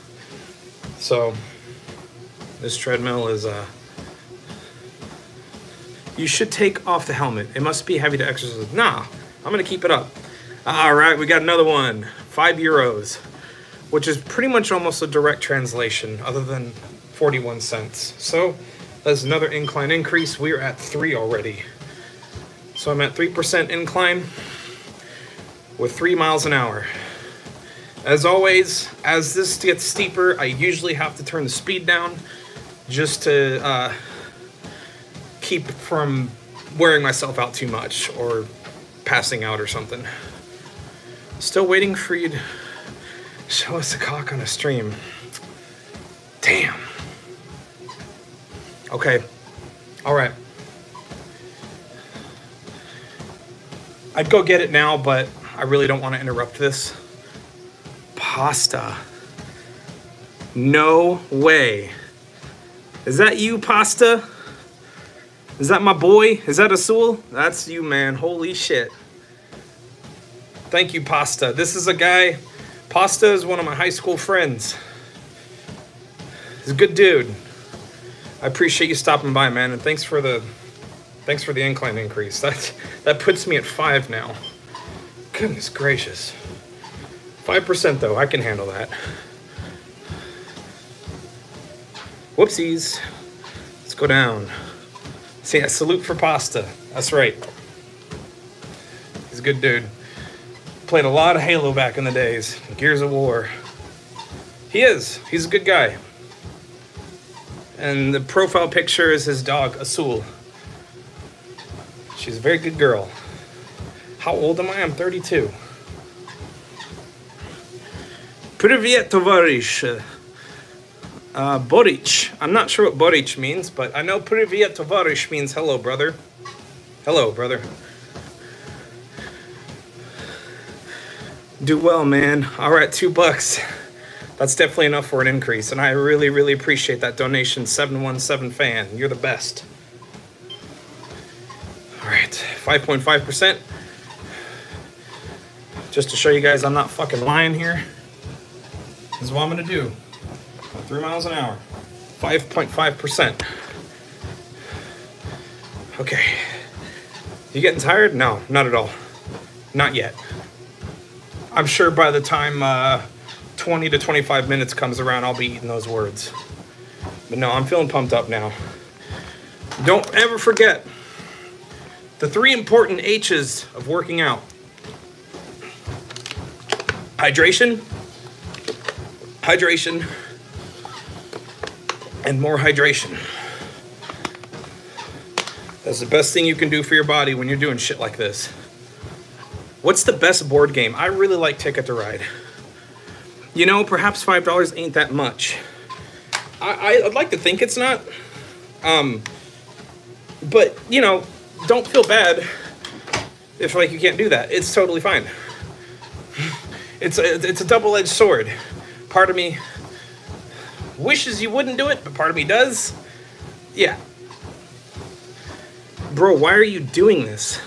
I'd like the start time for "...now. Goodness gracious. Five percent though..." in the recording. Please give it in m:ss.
1:24.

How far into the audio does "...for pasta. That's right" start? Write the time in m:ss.
1:36.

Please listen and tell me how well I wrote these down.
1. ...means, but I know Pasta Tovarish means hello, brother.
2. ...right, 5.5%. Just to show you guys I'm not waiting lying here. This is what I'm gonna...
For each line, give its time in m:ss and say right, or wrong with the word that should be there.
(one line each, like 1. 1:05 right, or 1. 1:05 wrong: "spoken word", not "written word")
1. 2:03 wrong: "Privia", not "Pasta"
2. 2:22 wrong: "fucking", not "waiting".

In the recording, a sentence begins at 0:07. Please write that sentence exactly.
It must be heavy to exercise.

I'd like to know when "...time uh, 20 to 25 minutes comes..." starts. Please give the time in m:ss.
2:42.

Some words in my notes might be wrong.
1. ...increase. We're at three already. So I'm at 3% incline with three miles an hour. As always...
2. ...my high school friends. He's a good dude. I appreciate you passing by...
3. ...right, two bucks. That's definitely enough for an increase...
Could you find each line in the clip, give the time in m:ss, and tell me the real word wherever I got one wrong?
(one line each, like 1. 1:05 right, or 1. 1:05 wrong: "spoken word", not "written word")
1. 0:19 right
2. 1:13 wrong: "stopping", not "passing"
3. 2:12 right.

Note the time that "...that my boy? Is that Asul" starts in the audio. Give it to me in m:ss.
1:05.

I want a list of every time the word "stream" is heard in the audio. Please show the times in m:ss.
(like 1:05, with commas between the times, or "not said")
0:44.